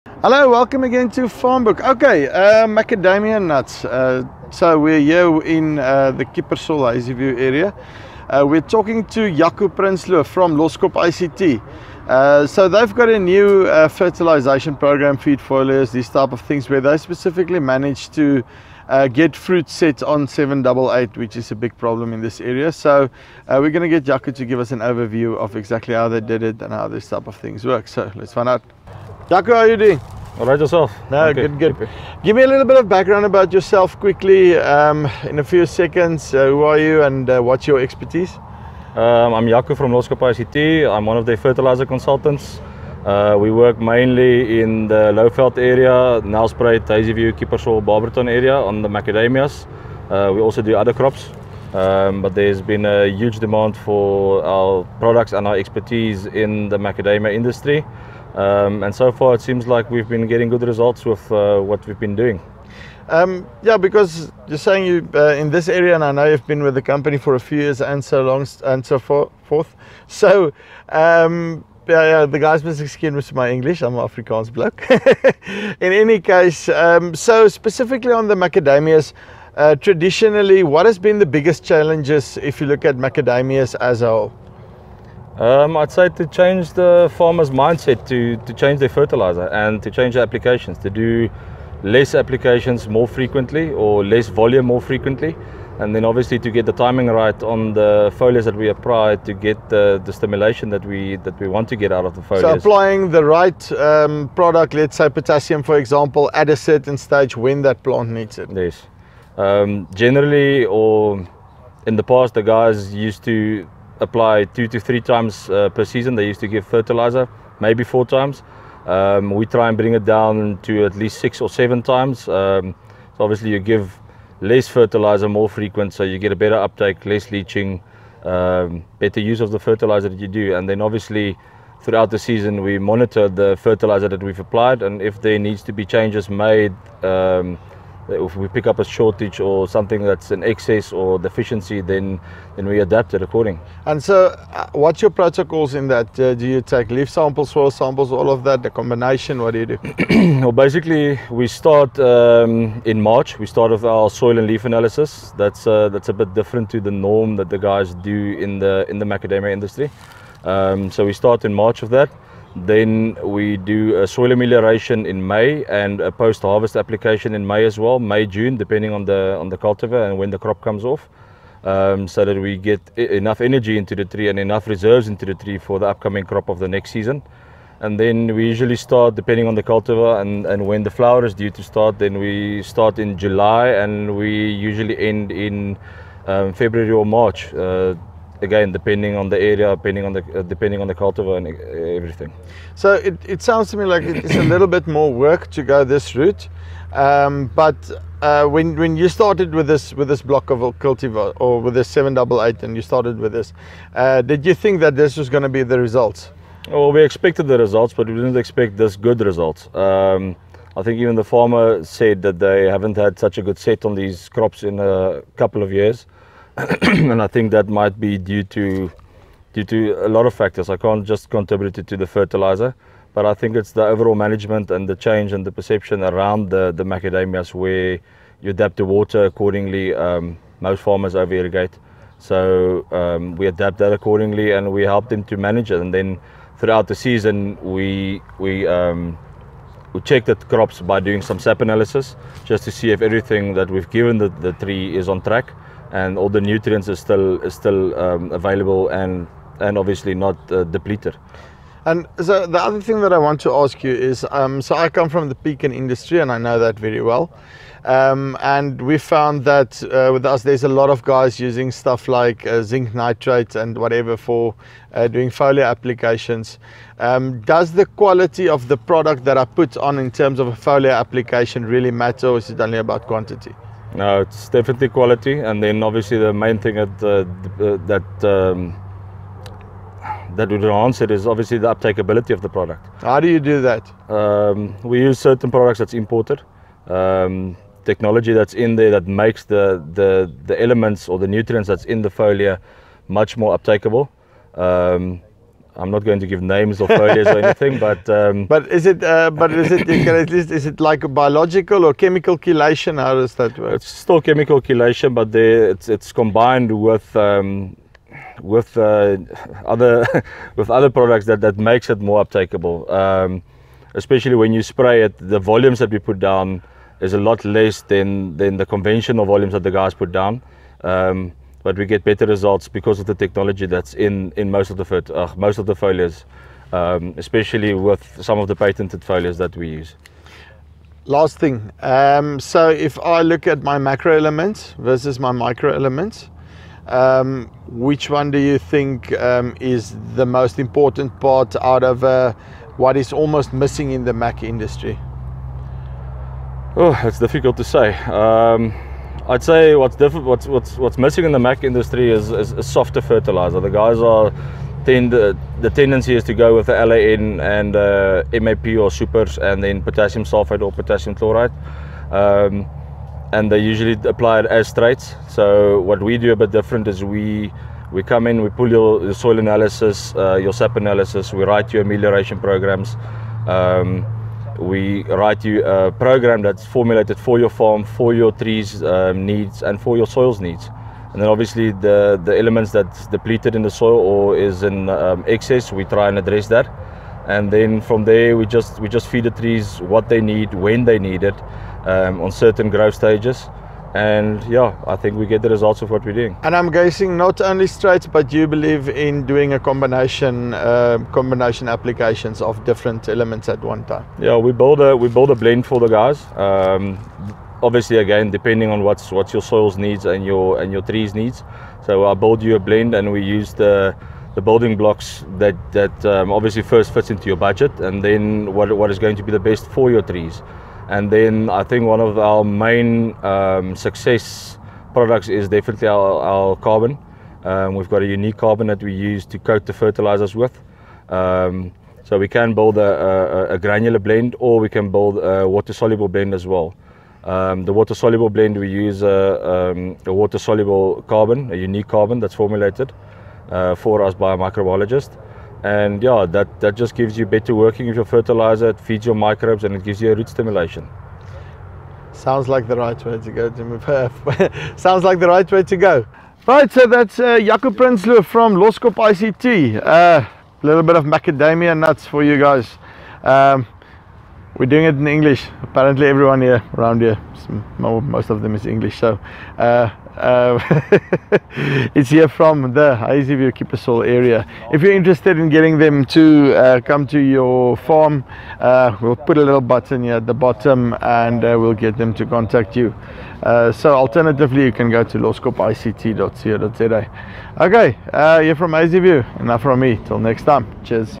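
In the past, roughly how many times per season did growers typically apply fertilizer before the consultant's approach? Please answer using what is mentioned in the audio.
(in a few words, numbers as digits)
4.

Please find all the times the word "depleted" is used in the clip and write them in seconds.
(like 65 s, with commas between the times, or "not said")
250 s, 383 s.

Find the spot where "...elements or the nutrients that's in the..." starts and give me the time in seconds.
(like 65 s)
290 s.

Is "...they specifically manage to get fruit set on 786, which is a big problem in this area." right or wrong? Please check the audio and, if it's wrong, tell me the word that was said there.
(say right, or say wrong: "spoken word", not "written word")
wrong: "788", not "786".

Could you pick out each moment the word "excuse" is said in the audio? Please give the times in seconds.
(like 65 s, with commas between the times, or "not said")
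72 s.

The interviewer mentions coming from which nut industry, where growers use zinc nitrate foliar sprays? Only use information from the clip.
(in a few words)
Pecan.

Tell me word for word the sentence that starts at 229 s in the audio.
Um, most farmers over irrigate, so um, we adapt that accordingly and we help them to manage it.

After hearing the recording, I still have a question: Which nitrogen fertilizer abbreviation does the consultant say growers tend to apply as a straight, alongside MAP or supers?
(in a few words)
LAN.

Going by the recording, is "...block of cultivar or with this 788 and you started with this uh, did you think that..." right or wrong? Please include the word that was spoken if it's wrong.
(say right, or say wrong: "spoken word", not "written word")
right.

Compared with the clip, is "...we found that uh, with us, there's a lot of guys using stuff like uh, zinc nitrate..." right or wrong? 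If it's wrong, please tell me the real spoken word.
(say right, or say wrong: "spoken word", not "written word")
right.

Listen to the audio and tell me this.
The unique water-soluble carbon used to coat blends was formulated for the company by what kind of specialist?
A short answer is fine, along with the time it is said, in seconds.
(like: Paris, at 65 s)
A microbiologist, at 444 s.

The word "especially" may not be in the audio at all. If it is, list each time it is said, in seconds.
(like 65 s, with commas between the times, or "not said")
313 s, 327 s.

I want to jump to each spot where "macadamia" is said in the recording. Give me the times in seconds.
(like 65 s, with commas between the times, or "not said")
2 s, 48 s, 56 s, 78 s, 82 s, 159 s, 226 s, 461 s.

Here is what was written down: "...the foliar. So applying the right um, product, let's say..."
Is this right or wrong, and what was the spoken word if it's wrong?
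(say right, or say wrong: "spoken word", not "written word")
right.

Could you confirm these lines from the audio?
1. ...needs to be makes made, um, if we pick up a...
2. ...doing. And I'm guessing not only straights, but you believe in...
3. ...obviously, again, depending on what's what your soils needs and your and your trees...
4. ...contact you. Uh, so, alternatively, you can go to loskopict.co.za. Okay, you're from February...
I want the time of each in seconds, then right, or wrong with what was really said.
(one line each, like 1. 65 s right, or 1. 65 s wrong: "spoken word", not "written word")
1. 135 s wrong: "changes", not "makes"
2. 396 s right
3. 407 s right
4. 482 s wrong: "Hazyview", not "February".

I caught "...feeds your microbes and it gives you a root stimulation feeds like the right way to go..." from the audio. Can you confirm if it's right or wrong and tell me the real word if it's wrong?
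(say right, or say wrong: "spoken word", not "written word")
wrong: "sounds", not "feeds".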